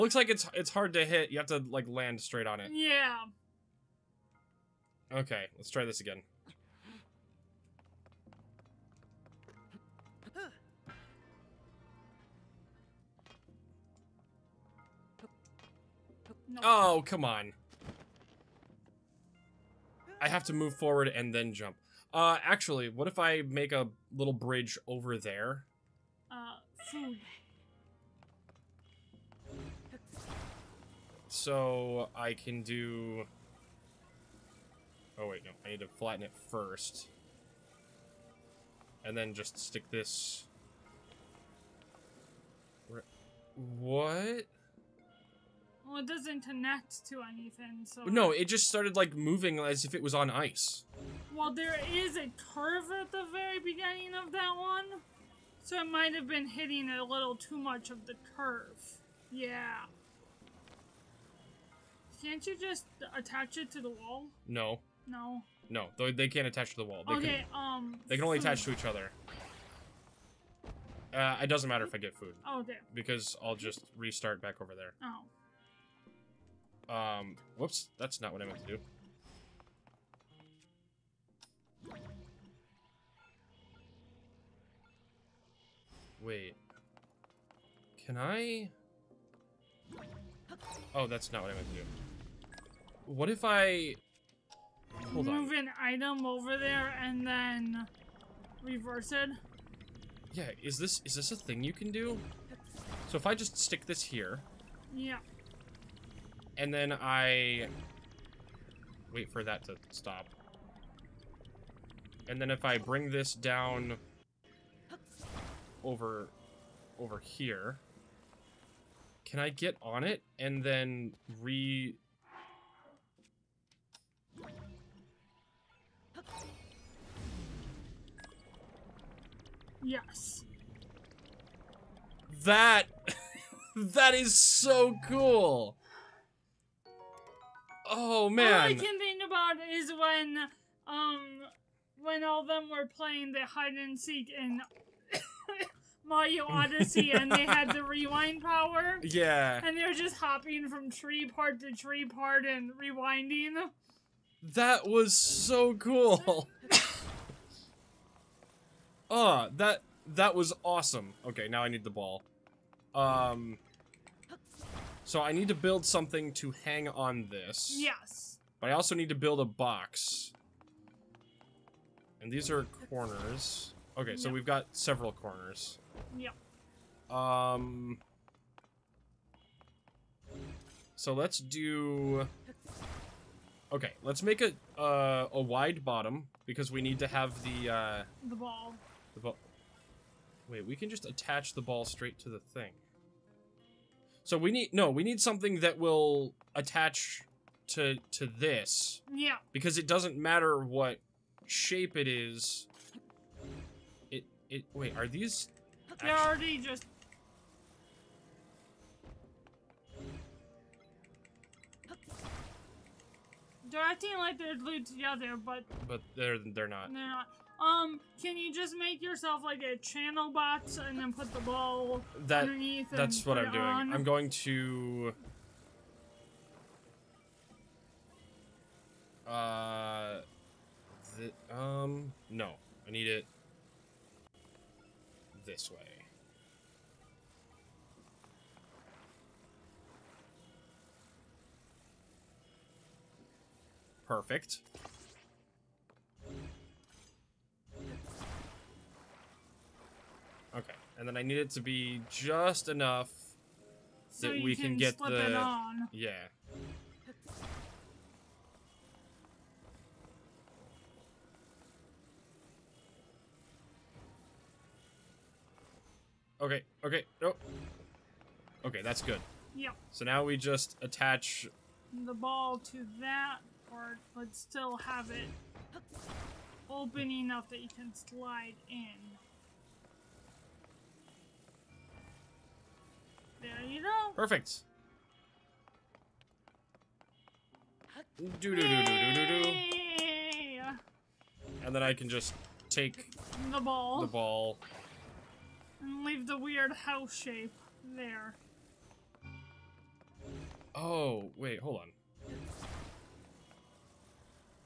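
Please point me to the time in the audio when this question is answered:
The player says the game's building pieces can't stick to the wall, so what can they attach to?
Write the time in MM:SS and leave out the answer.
01:08.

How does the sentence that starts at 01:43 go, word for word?
So if I just stick this here...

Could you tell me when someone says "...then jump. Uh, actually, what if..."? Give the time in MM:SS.
00:21.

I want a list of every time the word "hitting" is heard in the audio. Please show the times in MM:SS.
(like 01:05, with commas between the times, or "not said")
00:56.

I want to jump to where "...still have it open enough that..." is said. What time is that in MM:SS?
04:34.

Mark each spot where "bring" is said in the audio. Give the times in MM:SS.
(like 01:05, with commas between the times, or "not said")
01:52.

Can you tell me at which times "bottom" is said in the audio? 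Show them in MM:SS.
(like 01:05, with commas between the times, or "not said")
03:05.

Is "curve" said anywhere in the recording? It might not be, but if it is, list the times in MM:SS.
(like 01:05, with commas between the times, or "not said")
00:52, 00:58.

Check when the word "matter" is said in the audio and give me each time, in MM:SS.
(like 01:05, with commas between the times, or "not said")
01:11, 03:20.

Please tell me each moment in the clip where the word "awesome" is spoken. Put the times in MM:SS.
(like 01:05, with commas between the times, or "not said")
02:40.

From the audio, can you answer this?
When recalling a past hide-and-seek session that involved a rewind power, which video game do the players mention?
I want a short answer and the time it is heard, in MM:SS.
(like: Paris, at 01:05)
Mario Odyssey, at 02:26.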